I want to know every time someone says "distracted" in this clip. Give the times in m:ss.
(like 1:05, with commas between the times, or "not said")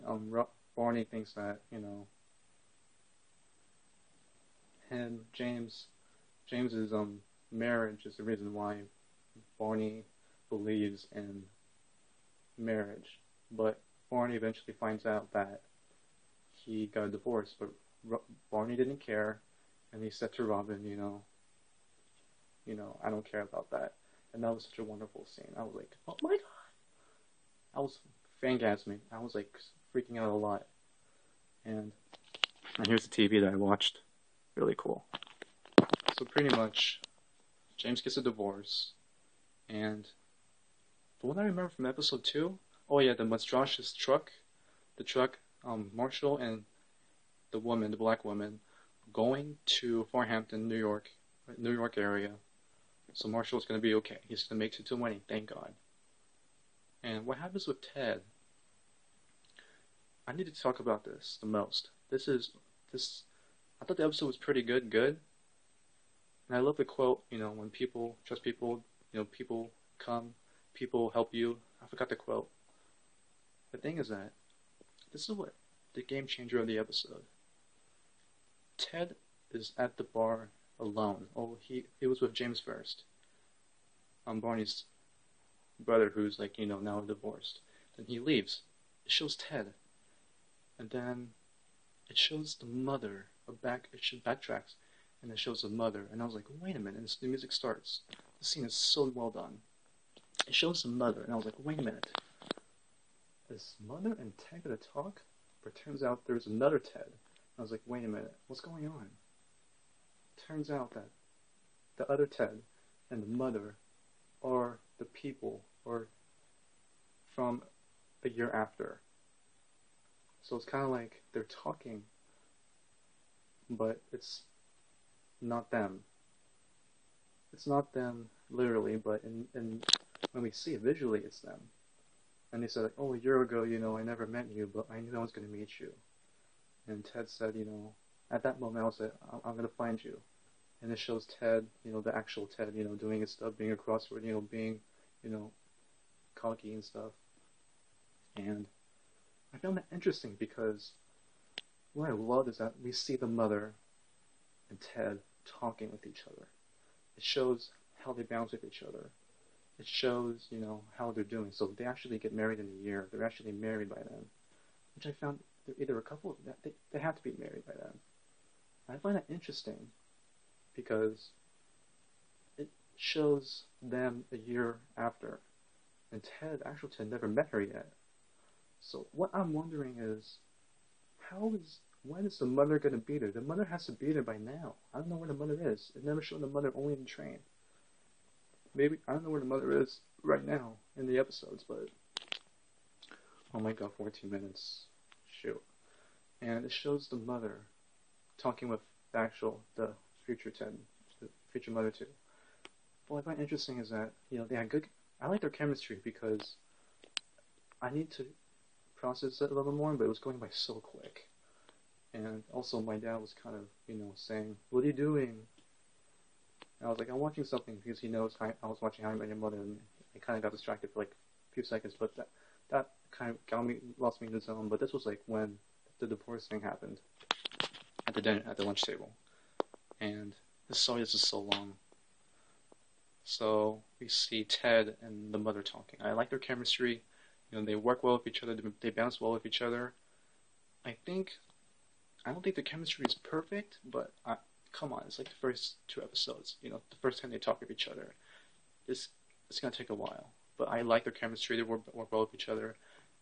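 3:40.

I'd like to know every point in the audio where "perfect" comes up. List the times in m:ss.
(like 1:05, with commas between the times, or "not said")
4:03.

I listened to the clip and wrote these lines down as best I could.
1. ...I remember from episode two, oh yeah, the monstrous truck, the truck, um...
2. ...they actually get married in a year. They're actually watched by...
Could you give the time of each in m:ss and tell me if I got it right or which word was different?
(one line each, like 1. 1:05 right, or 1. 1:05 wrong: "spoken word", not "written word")
1. 0:41 right
2. 2:41 wrong: "married", not "watched".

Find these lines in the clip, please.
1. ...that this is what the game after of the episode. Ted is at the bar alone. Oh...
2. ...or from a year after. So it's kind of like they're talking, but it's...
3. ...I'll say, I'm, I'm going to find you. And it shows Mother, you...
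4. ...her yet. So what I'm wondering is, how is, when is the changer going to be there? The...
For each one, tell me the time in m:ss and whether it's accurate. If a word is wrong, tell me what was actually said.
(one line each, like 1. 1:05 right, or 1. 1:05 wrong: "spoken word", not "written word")
1. 1:14 wrong: "changer", not "after"
2. 1:55 right
3. 2:18 wrong: "Ted", not "Mother"
4. 2:57 wrong: "mother", not "changer".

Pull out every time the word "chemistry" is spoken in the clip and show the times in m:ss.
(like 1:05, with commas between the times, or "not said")
3:25, 3:56, 4:02, 4:11.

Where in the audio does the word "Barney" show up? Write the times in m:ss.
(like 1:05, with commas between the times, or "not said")
0:00, 0:09, 0:14, 0:18, 1:24.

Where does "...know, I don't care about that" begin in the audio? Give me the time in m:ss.
0:22.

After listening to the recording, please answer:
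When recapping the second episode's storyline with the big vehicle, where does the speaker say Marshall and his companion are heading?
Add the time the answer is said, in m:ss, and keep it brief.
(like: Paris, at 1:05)
Farhampton, at 0:50.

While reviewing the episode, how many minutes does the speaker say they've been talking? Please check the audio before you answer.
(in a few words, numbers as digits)
14.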